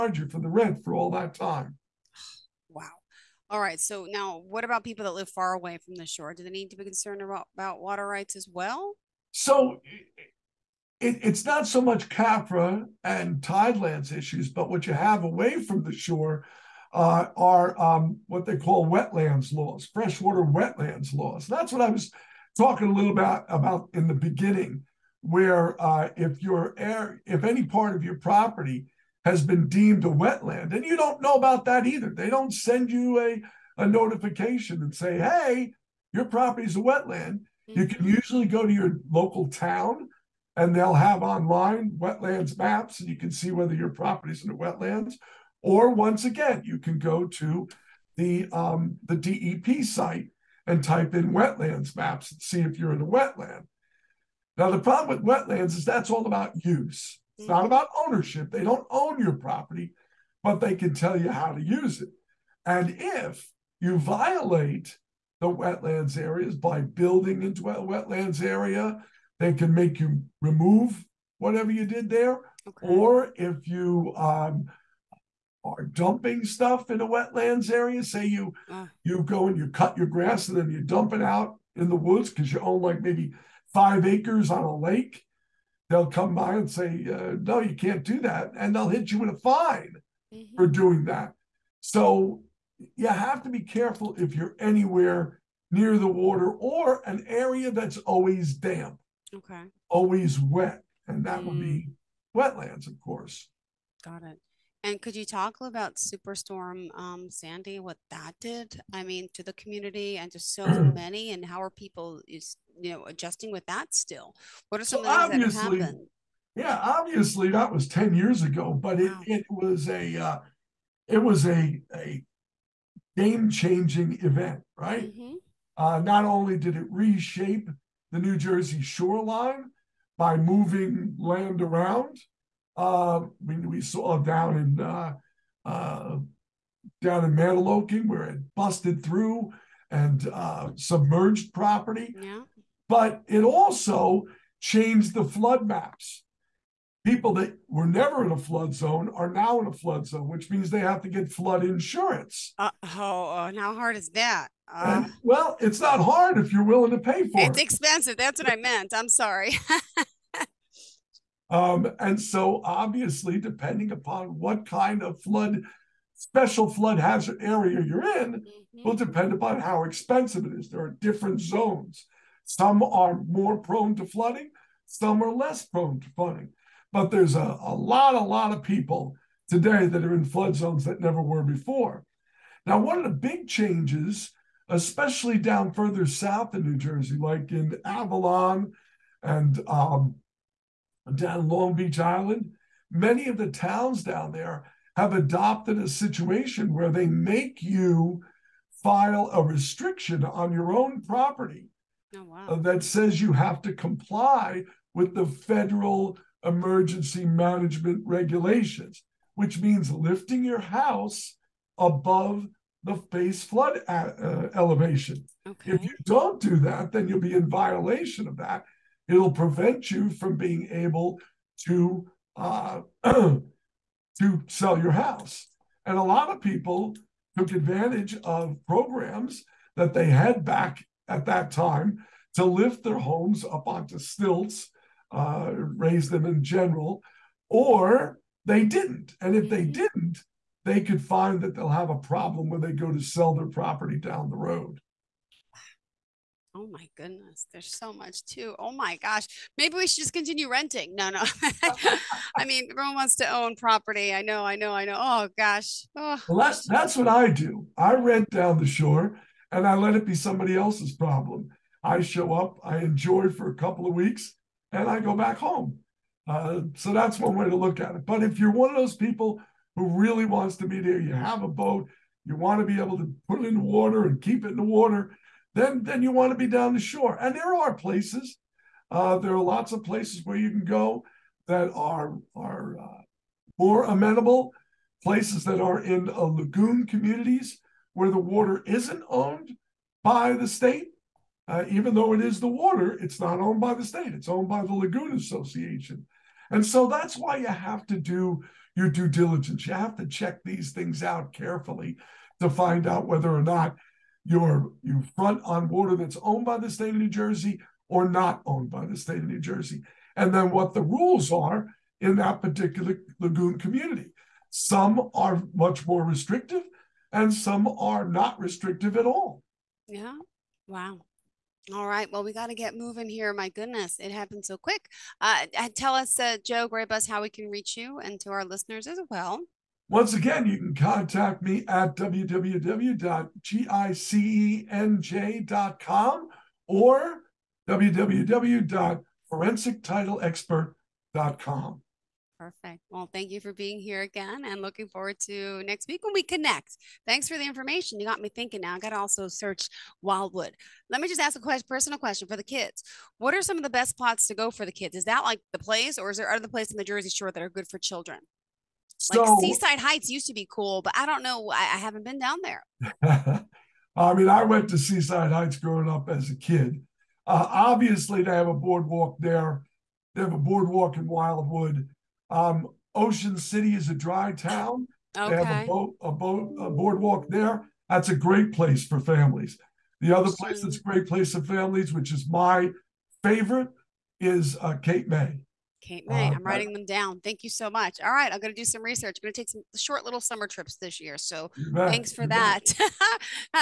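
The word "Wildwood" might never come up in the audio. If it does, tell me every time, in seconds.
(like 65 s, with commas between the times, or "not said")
350 s, 371 s.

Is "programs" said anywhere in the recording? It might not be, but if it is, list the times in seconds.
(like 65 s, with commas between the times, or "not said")
228 s.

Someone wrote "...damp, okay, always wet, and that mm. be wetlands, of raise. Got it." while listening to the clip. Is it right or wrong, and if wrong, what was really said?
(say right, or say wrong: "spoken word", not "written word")
wrong: "course", not "raise".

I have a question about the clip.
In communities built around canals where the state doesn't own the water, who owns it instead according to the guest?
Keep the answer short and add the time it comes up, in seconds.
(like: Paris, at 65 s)
The lagoon association, at 294 s.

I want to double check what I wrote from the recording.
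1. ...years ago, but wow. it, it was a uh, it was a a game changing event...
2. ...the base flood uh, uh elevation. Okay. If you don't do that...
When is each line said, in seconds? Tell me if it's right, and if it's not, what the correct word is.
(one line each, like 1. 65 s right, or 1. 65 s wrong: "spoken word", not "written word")
1. 118 s right
2. 212 s right.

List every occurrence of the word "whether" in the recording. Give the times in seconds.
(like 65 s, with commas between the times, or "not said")
43 s, 303 s.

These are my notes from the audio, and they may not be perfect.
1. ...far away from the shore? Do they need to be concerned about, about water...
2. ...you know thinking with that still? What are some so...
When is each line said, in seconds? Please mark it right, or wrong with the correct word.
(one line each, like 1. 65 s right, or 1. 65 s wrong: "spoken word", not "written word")
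1. 5 s right
2. 112 s wrong: "adjusting", not "thinking".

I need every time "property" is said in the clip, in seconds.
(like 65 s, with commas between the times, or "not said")
28 s, 36 s, 43 s, 59 s, 141 s, 201 s, 243 s, 253 s.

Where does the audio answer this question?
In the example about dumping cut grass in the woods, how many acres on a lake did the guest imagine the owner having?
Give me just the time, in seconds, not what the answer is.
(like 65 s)
83 s.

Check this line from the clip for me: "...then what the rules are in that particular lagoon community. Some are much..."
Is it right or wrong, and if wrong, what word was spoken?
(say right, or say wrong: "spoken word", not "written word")
right.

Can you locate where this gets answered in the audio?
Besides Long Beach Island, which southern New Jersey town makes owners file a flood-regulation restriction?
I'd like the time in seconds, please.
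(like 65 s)
187 s.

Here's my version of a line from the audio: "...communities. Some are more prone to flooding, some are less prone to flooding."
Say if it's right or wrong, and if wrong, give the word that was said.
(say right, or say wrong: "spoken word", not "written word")
wrong: "zones", not "communities".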